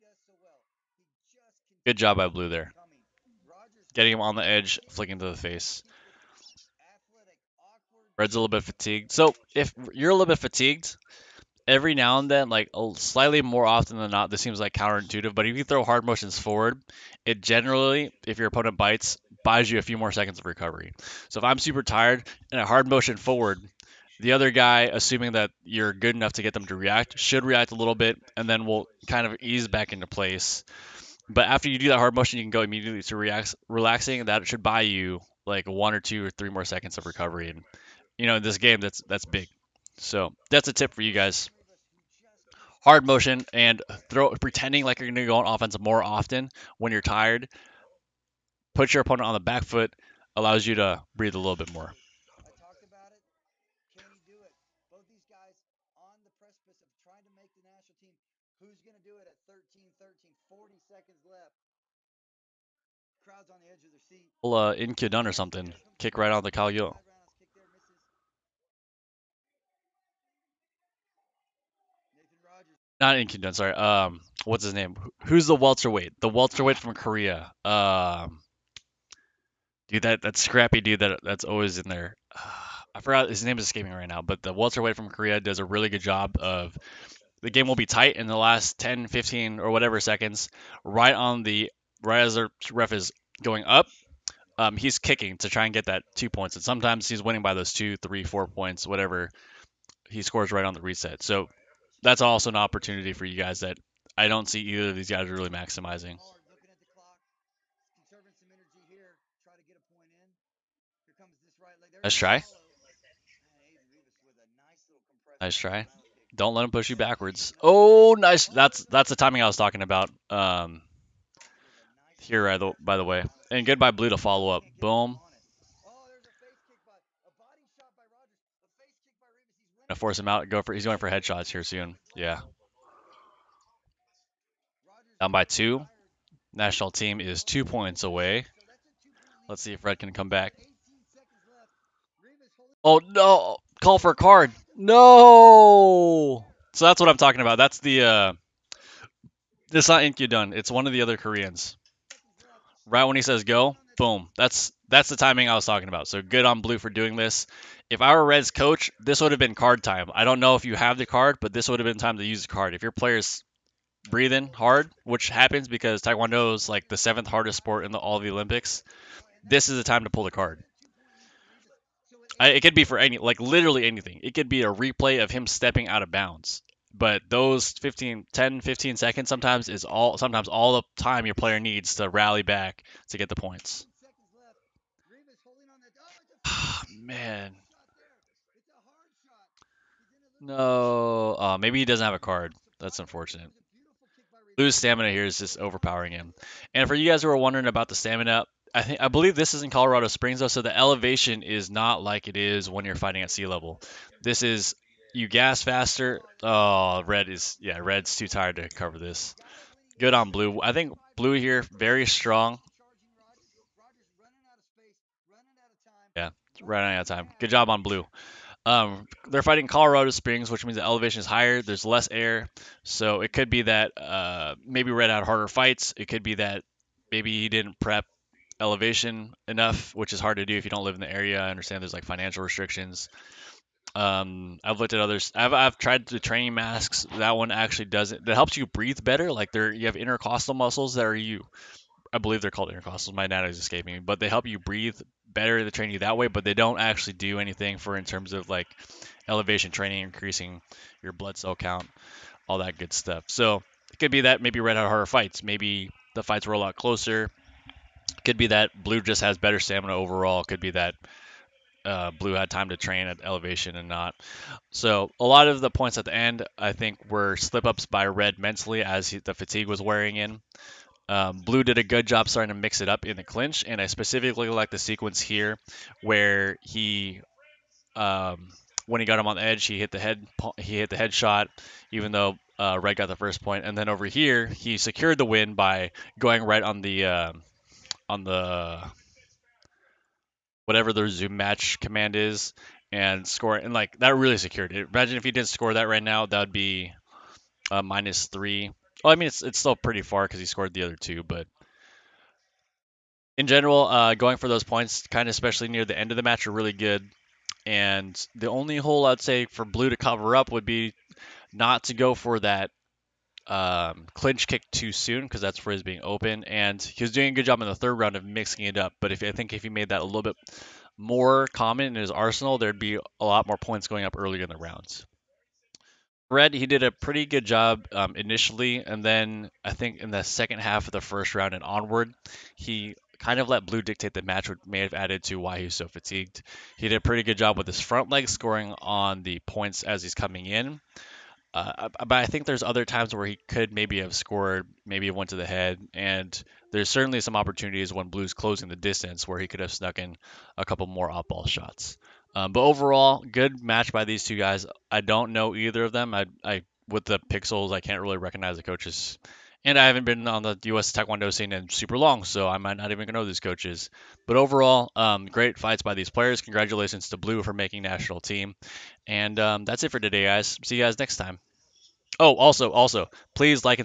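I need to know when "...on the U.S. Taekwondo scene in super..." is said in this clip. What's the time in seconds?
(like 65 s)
360 s.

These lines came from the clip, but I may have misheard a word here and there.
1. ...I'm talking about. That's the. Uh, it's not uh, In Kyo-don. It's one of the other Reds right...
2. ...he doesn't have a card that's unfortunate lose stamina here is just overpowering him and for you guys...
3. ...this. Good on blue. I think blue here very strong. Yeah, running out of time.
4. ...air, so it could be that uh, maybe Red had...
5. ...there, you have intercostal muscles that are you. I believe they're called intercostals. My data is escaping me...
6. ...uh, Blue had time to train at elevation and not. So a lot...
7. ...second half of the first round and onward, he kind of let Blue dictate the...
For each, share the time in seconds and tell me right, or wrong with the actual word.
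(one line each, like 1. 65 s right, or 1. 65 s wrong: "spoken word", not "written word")
1. 147 s wrong: "Koreans", not "Reds"
2. 191 s right
3. 208 s right
4. 222 s right
5. 239 s right
6. 261 s right
7. 330 s right.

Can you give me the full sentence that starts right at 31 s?
But after you do that hard motion, you can go immediately to relax, relaxing.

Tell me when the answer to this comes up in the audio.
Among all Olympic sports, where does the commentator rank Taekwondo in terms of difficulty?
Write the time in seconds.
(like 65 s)
166 s.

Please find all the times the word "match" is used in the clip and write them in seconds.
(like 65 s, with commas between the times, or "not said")
291 s, 306 s, 334 s, 353 s.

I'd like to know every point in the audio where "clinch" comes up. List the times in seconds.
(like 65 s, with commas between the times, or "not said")
273 s, 314 s.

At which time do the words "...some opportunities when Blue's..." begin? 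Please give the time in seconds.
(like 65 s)
347 s.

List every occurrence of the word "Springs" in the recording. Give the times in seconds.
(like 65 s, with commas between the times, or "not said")
200 s, 220 s.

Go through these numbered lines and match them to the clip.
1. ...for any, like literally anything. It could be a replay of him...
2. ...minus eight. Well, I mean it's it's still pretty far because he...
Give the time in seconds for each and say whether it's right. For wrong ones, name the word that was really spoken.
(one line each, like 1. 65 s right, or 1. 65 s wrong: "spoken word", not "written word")
1. 172 s right
2. 297 s wrong: "three", not "eight".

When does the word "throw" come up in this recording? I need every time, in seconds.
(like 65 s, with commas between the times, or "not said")
15 s, 44 s.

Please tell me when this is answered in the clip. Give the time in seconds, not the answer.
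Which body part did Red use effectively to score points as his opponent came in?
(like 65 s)
337 s.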